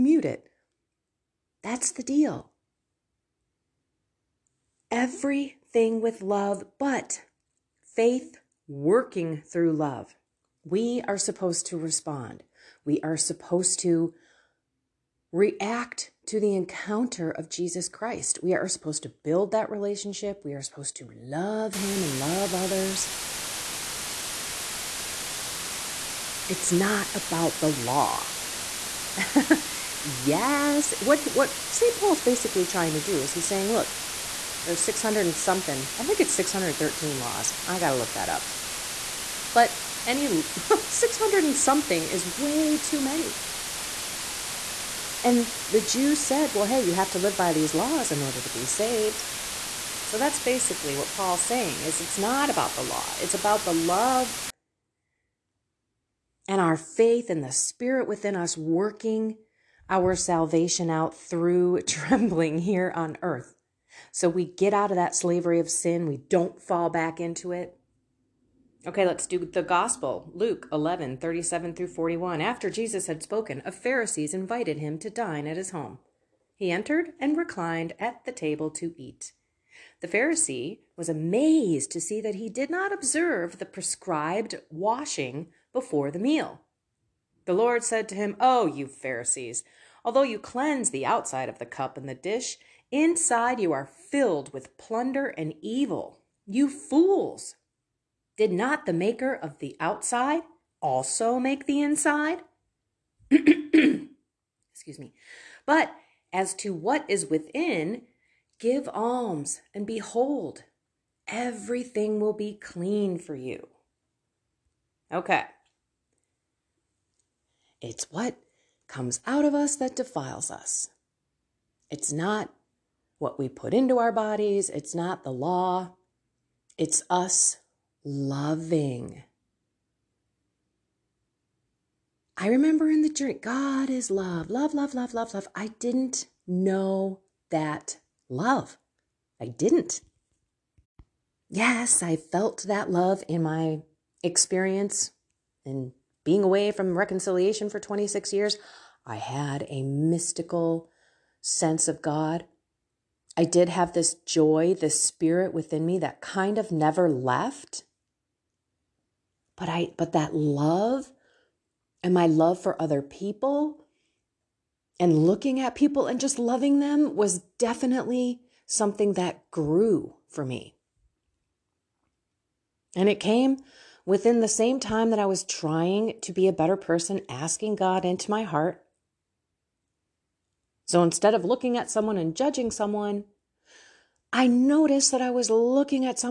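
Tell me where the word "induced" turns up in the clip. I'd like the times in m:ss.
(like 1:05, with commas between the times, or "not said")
not said.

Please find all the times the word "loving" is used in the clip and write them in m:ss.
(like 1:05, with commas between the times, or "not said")
2:08, 2:46.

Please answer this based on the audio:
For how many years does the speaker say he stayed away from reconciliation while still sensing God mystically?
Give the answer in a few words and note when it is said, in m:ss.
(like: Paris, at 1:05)
26, at 2:27.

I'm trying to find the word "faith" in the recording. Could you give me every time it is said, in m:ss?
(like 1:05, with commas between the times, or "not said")
0:07, 0:56.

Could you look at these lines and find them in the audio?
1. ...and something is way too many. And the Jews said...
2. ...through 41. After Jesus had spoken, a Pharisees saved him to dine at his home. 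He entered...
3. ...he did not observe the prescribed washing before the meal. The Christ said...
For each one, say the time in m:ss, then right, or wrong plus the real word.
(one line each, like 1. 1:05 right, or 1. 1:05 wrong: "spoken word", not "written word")
1. 0:41 right
2. 1:11 wrong: "invited", not "saved"
3. 1:22 wrong: "Lord", not "Christ".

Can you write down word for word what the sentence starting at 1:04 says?
So we get out of that slavery of sin, we don't fall back into it.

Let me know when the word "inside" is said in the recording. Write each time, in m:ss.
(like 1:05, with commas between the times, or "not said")
1:32, 1:41.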